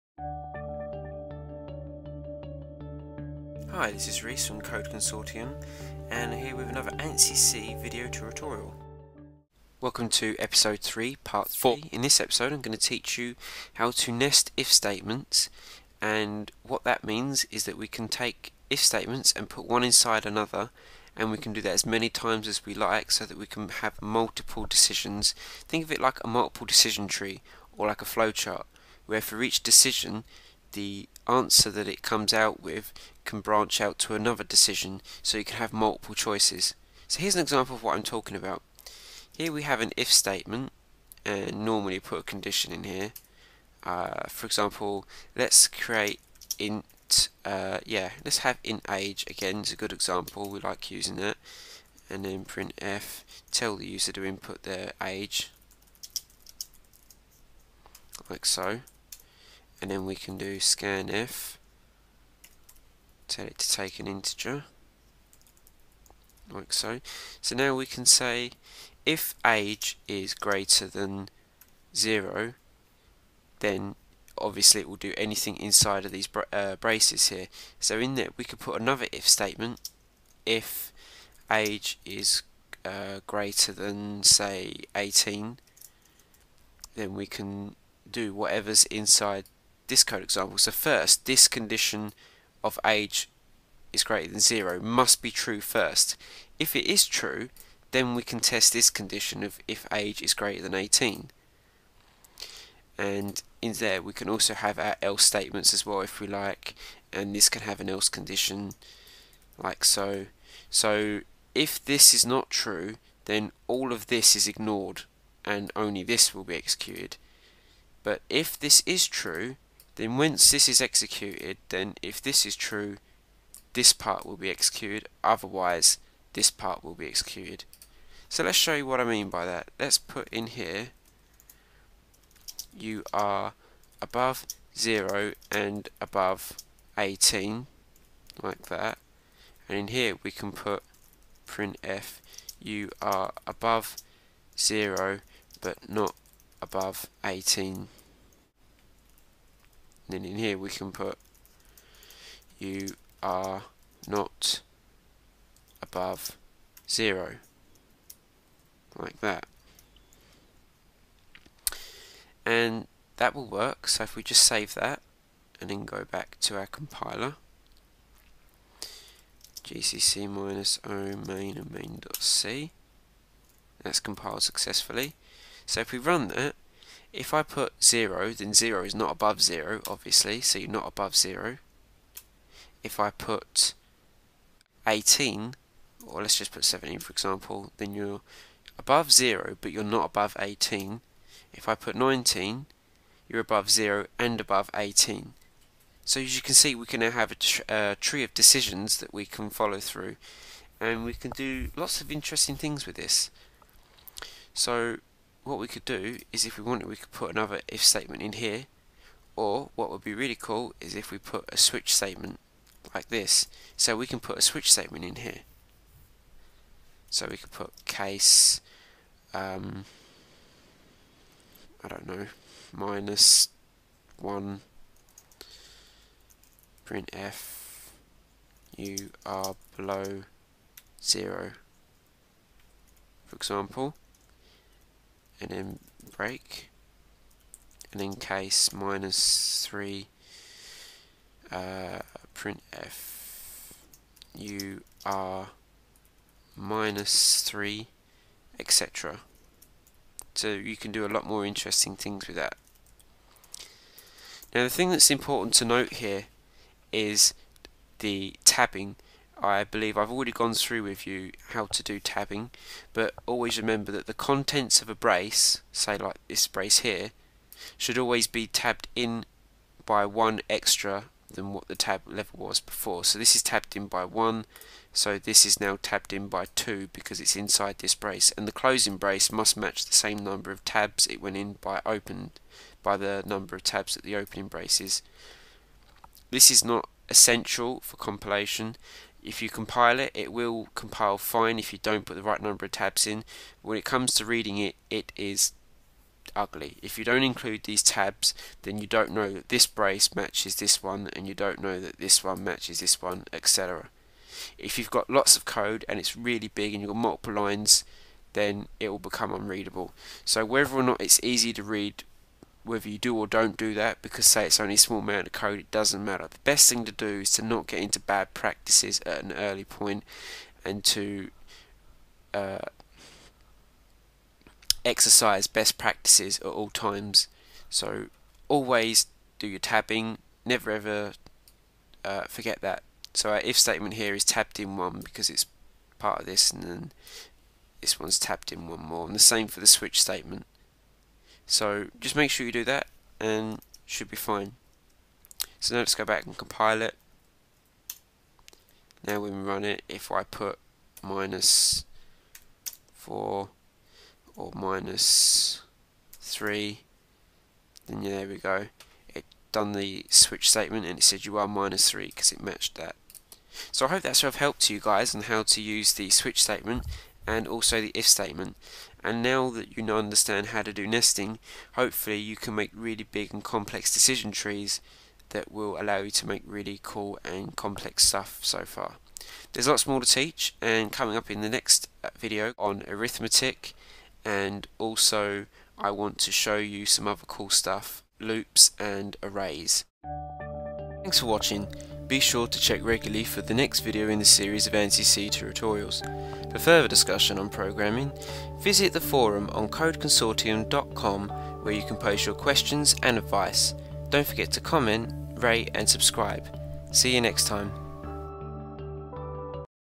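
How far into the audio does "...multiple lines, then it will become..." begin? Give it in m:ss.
5:06.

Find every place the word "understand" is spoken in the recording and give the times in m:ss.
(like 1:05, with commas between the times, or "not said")
6:09.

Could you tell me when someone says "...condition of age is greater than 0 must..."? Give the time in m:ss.
1:31.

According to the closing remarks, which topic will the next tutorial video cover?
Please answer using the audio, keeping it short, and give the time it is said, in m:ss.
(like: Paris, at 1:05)
arithmetic, at 6:22.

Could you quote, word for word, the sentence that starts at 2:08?
So let's show you what I mean by that.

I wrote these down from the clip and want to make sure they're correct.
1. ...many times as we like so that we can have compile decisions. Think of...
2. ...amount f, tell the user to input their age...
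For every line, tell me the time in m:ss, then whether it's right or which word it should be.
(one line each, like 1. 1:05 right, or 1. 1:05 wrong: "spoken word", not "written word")
1. 0:21 wrong: "multiple", not "compile"
2. 0:52 wrong: "print", not "amount".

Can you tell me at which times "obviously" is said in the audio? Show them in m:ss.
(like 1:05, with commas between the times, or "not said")
1:14, 2:59.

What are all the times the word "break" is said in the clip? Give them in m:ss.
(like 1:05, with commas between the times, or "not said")
3:56.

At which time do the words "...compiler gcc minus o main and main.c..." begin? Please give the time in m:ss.
2:46.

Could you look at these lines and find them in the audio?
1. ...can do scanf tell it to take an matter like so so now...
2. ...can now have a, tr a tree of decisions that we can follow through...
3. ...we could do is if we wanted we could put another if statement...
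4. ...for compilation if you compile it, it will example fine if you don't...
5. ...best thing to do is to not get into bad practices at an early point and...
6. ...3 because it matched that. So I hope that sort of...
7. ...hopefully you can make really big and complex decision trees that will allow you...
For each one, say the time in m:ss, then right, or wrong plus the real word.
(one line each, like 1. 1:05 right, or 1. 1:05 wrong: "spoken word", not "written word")
1. 1:00 wrong: "integer", not "matter"
2. 3:16 right
3. 3:25 right
4. 4:47 wrong: "compile", not "example"
5. 5:16 right
6. 6:01 right
7. 6:11 right.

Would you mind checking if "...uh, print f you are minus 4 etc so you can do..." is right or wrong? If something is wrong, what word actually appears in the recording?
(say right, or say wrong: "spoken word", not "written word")
wrong: "3", not "4".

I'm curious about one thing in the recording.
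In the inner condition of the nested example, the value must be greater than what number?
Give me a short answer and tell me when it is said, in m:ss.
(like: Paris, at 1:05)
18, at 1:23.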